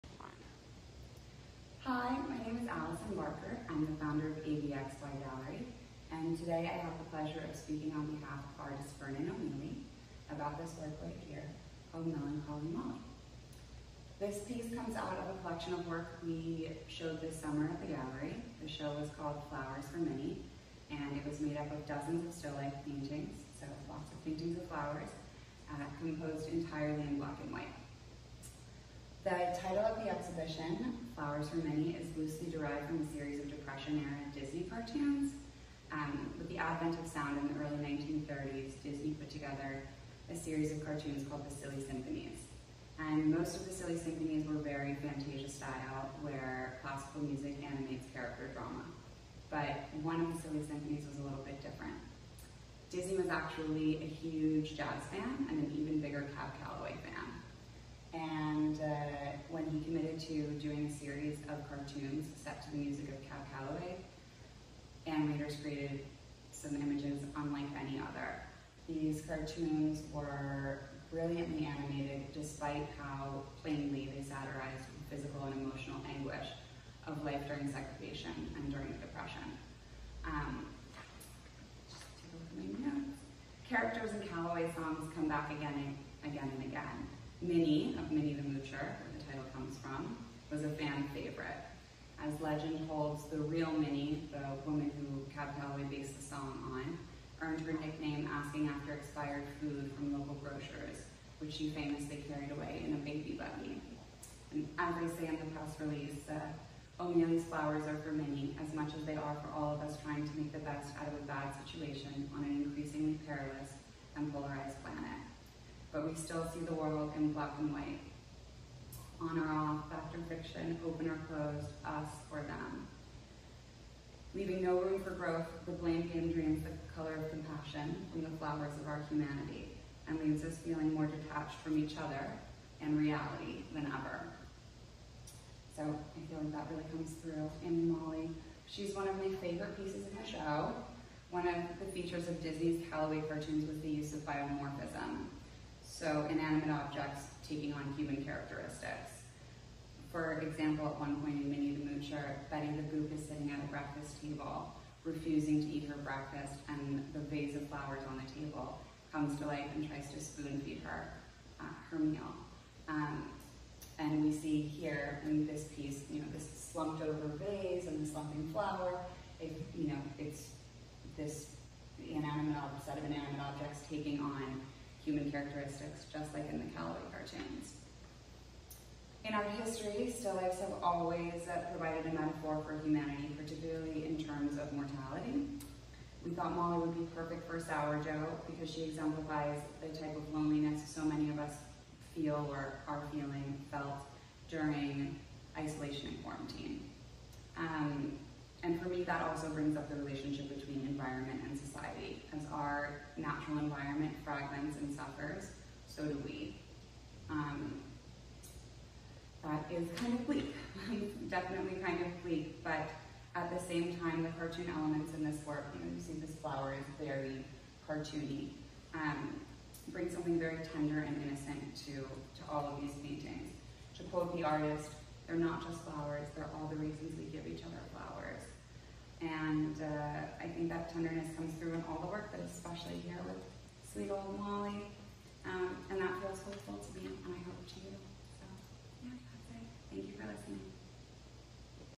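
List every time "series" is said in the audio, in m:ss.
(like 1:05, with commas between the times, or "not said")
0:33, 0:40, 1:00.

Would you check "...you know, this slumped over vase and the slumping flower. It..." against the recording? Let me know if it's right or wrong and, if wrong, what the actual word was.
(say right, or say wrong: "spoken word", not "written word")
right.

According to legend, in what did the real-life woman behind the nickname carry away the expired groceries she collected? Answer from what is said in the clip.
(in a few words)
a baby buggy.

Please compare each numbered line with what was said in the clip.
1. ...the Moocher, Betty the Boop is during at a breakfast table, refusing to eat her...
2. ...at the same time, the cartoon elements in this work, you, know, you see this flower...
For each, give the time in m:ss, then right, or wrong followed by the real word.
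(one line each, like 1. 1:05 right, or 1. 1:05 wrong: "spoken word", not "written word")
1. 2:31 wrong: "sitting", not "during"
2. 3:33 right.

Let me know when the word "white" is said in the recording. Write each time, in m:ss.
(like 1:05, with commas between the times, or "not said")
0:27, 1:57.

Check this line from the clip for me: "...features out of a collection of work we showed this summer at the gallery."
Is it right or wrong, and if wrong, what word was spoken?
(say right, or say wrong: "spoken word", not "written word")
wrong: "comes", not "features".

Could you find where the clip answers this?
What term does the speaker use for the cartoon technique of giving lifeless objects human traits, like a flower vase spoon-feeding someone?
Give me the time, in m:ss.
2:24.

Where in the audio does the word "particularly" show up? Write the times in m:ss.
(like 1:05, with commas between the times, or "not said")
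3:03.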